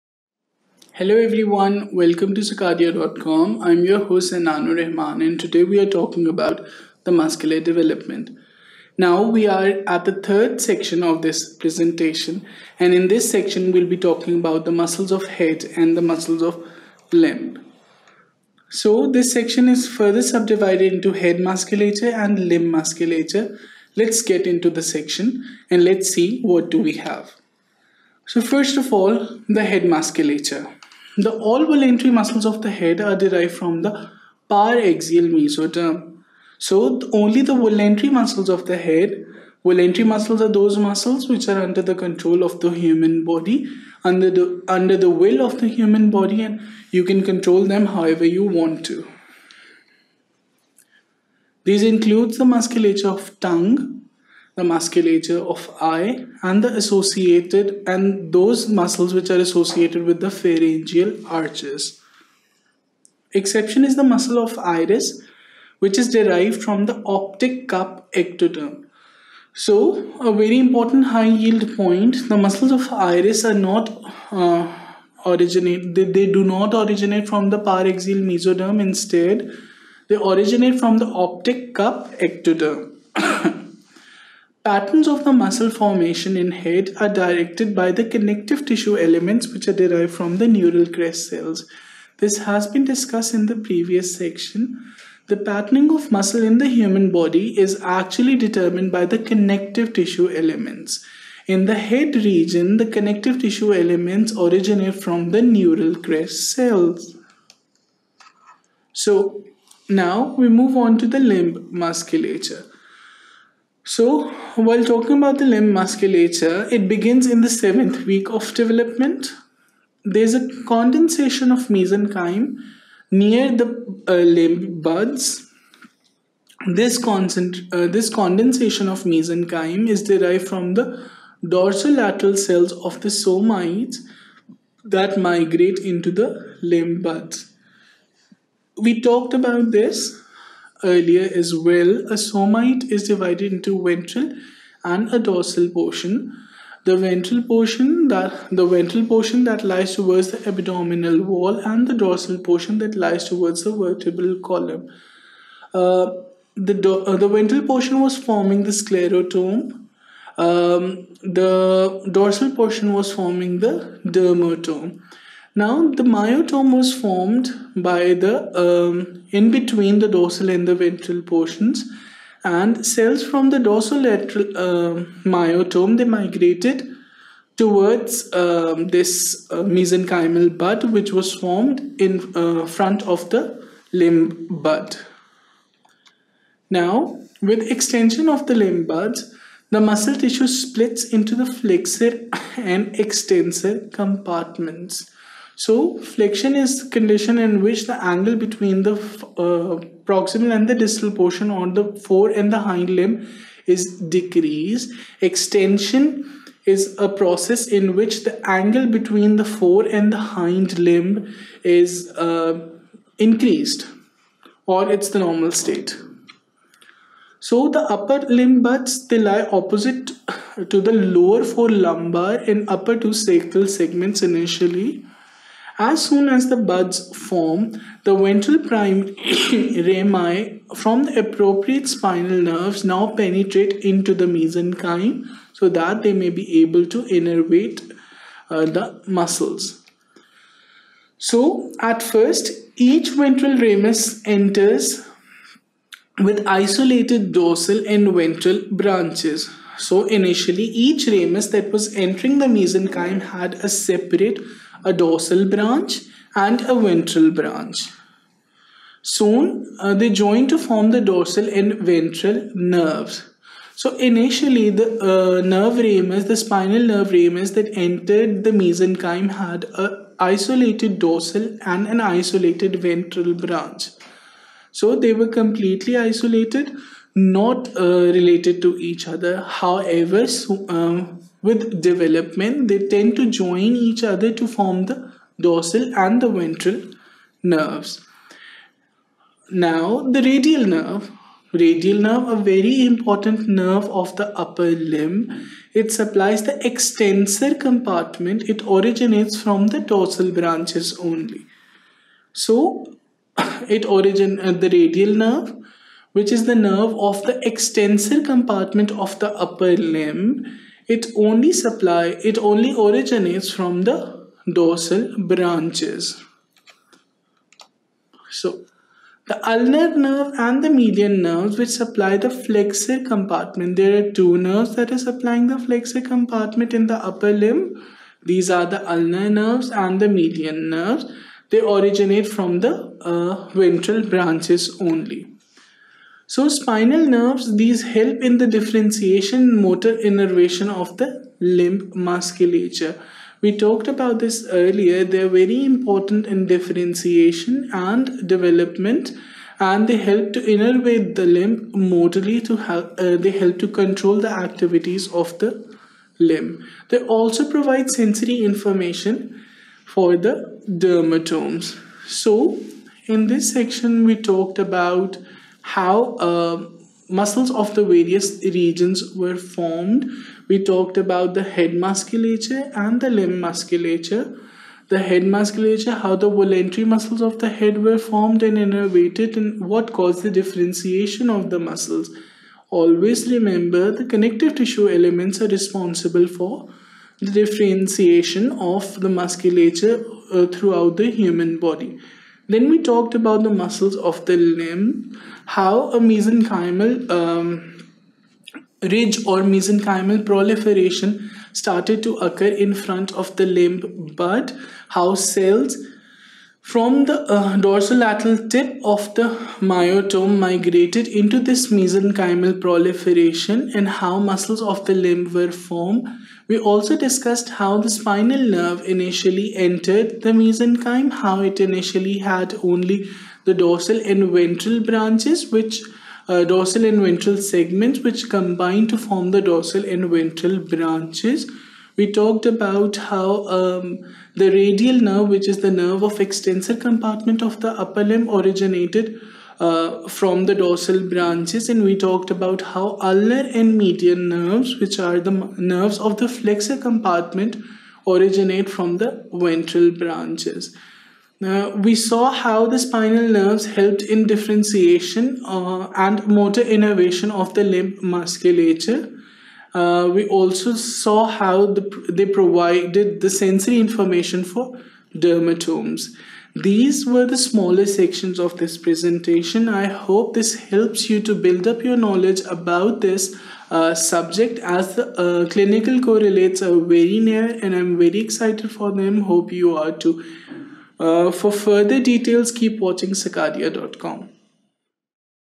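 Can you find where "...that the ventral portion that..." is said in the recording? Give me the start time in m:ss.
2:28.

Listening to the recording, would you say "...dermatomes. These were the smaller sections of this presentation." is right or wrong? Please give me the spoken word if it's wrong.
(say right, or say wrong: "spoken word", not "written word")
right.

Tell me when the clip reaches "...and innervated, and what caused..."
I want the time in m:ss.
6:18.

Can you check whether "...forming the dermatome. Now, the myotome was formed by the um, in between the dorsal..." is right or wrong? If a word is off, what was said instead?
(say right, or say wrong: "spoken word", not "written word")
right.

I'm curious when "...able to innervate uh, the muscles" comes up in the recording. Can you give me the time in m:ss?
3:56.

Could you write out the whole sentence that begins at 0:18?
So this section is further subdivided into head musculature and limb musculature.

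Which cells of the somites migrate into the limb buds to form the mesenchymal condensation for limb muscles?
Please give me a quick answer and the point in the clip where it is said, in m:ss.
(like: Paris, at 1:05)
Dorsolateral cells, at 2:11.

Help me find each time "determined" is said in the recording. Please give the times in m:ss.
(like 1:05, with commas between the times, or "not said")
1:38.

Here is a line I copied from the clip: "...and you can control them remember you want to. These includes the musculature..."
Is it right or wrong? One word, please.
wrong.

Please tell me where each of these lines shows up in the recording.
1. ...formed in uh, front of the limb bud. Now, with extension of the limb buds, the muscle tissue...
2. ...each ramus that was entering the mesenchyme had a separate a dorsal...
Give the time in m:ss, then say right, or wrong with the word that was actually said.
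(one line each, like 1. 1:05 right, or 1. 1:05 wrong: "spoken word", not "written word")
1. 3:01 right
2. 4:10 right.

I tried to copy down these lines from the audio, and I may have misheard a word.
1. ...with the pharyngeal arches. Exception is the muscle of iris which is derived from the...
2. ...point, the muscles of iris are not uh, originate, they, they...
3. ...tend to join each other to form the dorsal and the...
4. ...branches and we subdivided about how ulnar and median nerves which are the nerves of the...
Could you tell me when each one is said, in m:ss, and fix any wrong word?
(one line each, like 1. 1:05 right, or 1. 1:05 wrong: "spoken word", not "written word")
1. 1:00 right
2. 1:11 right
3. 4:42 right
4. 7:21 wrong: "talked", not "subdivided".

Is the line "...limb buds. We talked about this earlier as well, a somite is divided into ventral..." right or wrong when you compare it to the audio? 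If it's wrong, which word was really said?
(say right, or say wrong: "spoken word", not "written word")
right.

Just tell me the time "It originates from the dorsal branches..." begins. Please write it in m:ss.
4:58.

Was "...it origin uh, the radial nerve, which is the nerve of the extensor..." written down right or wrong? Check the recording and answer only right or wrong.
right.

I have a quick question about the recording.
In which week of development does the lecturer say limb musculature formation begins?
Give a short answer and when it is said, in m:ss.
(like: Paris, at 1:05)
Seventh week, at 1:57.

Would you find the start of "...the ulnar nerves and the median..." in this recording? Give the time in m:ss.
5:28.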